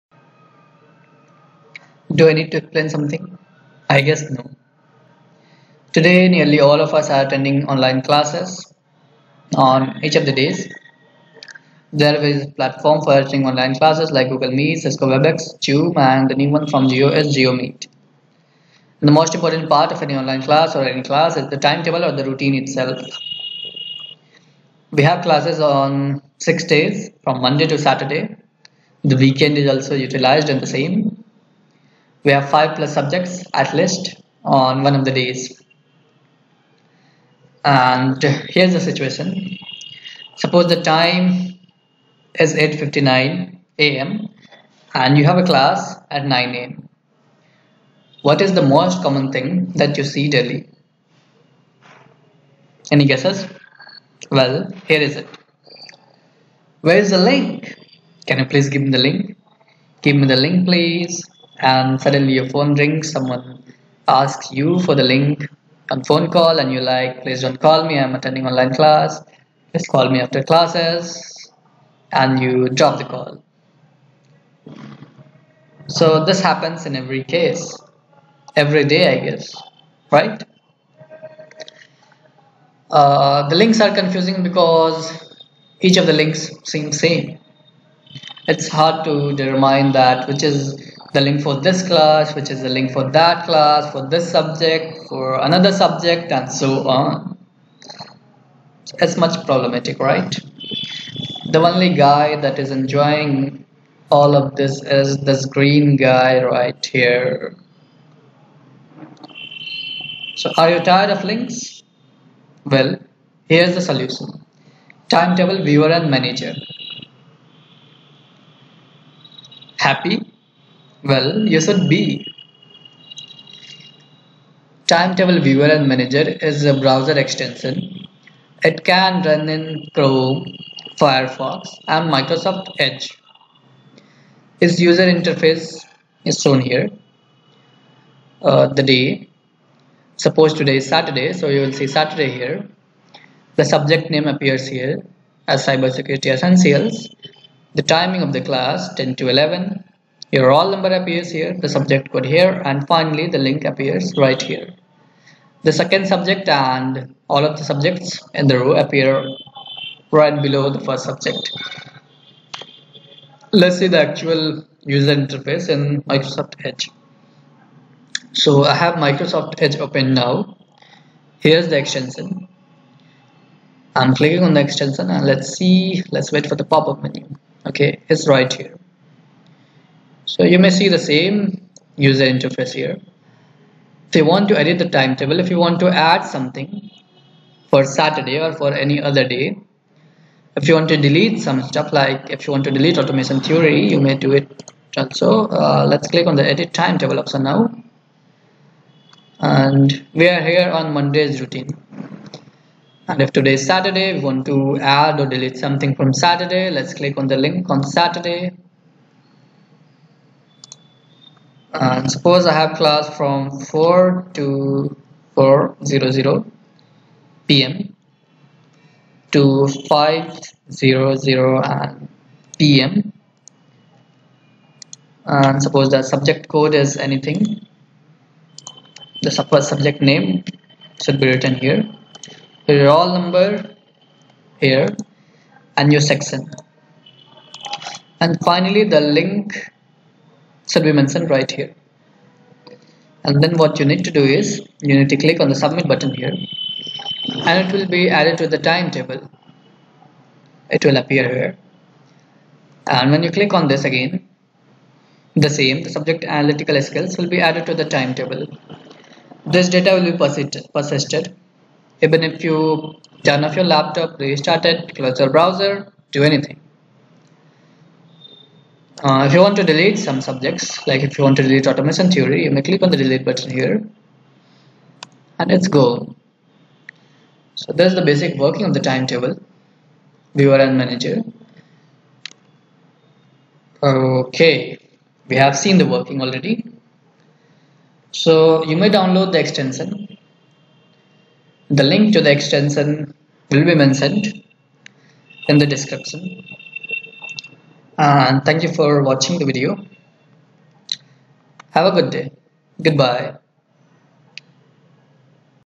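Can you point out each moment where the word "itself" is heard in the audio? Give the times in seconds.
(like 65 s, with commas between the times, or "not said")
22 s.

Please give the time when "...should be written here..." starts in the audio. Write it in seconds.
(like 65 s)
231 s.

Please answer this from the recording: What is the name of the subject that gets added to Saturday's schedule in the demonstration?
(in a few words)
Analytical Skills.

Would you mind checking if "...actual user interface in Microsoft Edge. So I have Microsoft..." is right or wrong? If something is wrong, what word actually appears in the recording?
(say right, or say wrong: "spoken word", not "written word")
right.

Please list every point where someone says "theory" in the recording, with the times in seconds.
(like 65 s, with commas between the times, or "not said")
193 s, 272 s.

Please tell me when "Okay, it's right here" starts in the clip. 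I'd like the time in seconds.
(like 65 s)
177 s.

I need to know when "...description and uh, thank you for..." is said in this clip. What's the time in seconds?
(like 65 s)
295 s.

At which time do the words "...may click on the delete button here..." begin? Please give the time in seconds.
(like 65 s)
272 s.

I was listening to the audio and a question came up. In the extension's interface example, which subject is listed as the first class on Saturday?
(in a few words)
Cybersecurity Essentials.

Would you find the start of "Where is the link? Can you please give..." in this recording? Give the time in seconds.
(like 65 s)
56 s.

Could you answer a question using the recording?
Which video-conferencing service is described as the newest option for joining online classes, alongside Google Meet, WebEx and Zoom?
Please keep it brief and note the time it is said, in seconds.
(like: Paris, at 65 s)
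JioMeet, at 17 s.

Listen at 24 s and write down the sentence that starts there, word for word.
We have classes on six days from Monday to Saturday.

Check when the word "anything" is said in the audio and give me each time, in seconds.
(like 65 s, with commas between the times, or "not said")
226 s, 266 s.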